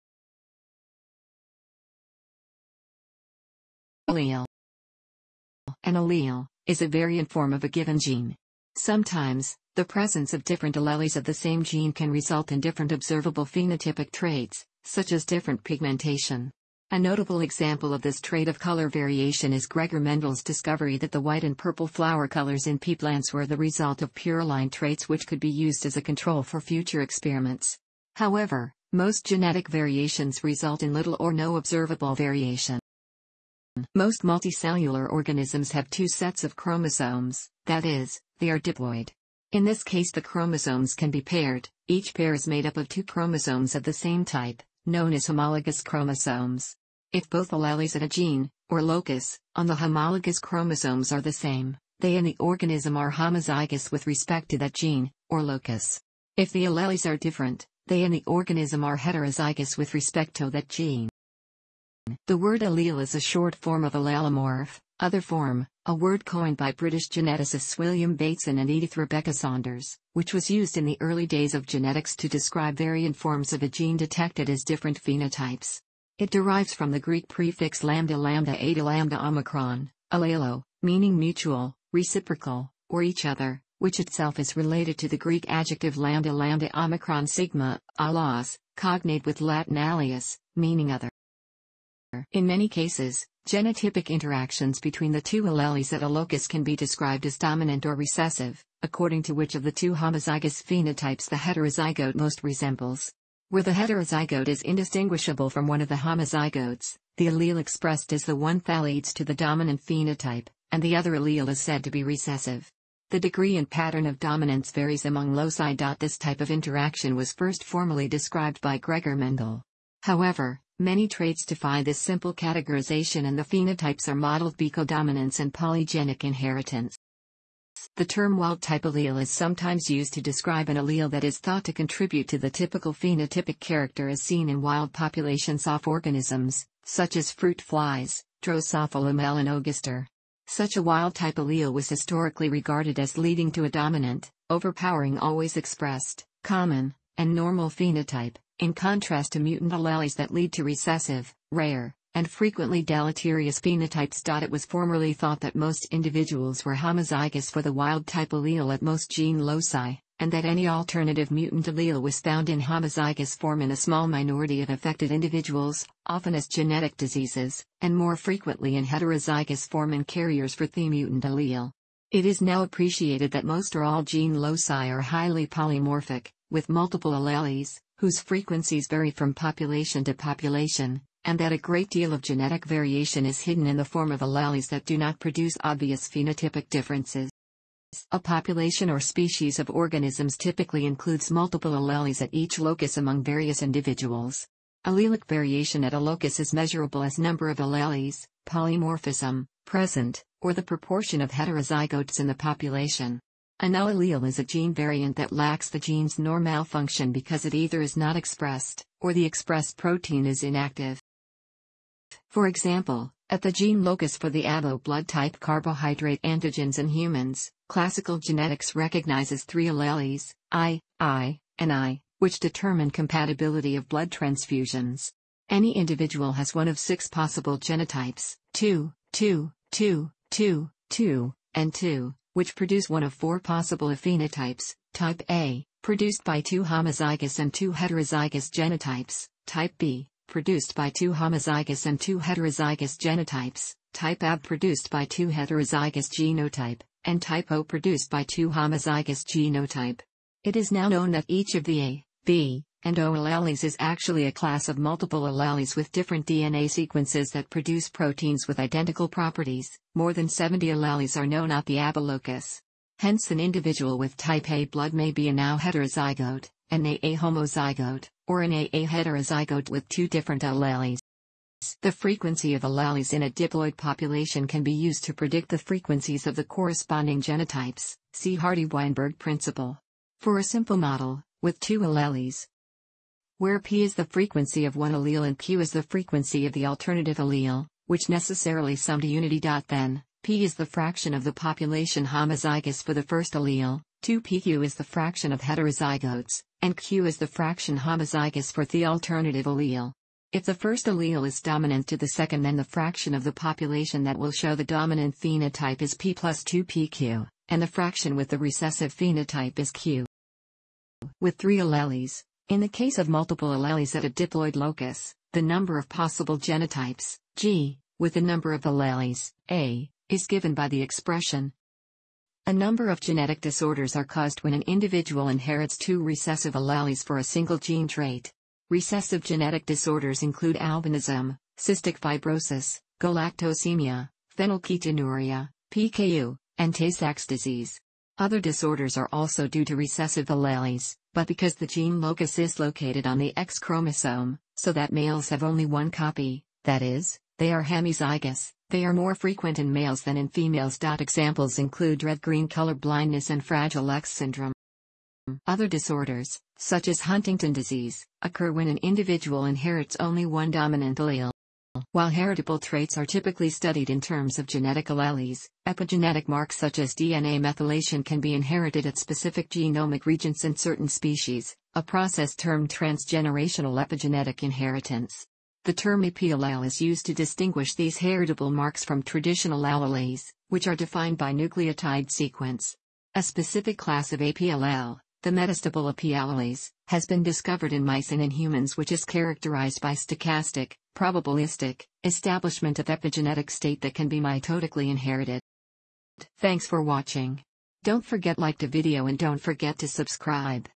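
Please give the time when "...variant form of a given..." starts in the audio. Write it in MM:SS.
00:06.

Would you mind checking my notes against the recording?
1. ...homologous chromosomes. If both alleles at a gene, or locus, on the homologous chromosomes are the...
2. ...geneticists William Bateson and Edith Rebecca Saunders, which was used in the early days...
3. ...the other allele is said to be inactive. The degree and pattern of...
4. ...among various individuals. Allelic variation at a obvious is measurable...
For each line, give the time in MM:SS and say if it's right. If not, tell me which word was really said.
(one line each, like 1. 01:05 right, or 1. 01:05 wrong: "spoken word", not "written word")
1. 00:45 right
2. 01:07 right
3. 01:50 wrong: "recessive", not "inactive"
4. 03:12 wrong: "locus", not "obvious".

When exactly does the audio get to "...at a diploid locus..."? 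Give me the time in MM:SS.
05:13.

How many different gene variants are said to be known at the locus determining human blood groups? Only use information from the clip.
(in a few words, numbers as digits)
More than 70.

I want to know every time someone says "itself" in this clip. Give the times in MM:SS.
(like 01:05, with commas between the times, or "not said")
01:24.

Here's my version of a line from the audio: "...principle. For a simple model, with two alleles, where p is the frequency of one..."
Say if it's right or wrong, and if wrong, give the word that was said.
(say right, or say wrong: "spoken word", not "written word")
right.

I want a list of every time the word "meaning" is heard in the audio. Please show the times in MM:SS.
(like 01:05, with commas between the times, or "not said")
01:20, 01:30.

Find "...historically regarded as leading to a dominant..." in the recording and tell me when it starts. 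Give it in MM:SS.
02:21.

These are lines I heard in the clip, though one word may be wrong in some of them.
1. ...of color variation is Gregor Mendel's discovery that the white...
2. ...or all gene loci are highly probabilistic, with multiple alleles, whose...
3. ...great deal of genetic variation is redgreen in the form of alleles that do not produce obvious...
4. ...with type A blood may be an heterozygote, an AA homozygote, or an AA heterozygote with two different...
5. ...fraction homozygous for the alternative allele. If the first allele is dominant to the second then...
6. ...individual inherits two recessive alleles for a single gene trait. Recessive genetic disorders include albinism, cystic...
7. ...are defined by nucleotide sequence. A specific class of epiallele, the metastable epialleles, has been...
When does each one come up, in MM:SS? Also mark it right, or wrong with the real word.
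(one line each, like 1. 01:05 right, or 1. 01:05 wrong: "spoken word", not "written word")
1. 00:18 right
2. 02:53 wrong: "polymorphic", not "probabilistic"
3. 03:01 wrong: "hidden", not "redgreen"
4. 04:23 right
5. 04:57 right
6. 05:24 right
7. 06:20 right.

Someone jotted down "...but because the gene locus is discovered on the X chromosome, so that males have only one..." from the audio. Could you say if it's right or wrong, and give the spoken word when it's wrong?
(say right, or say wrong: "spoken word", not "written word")
wrong: "located", not "discovered".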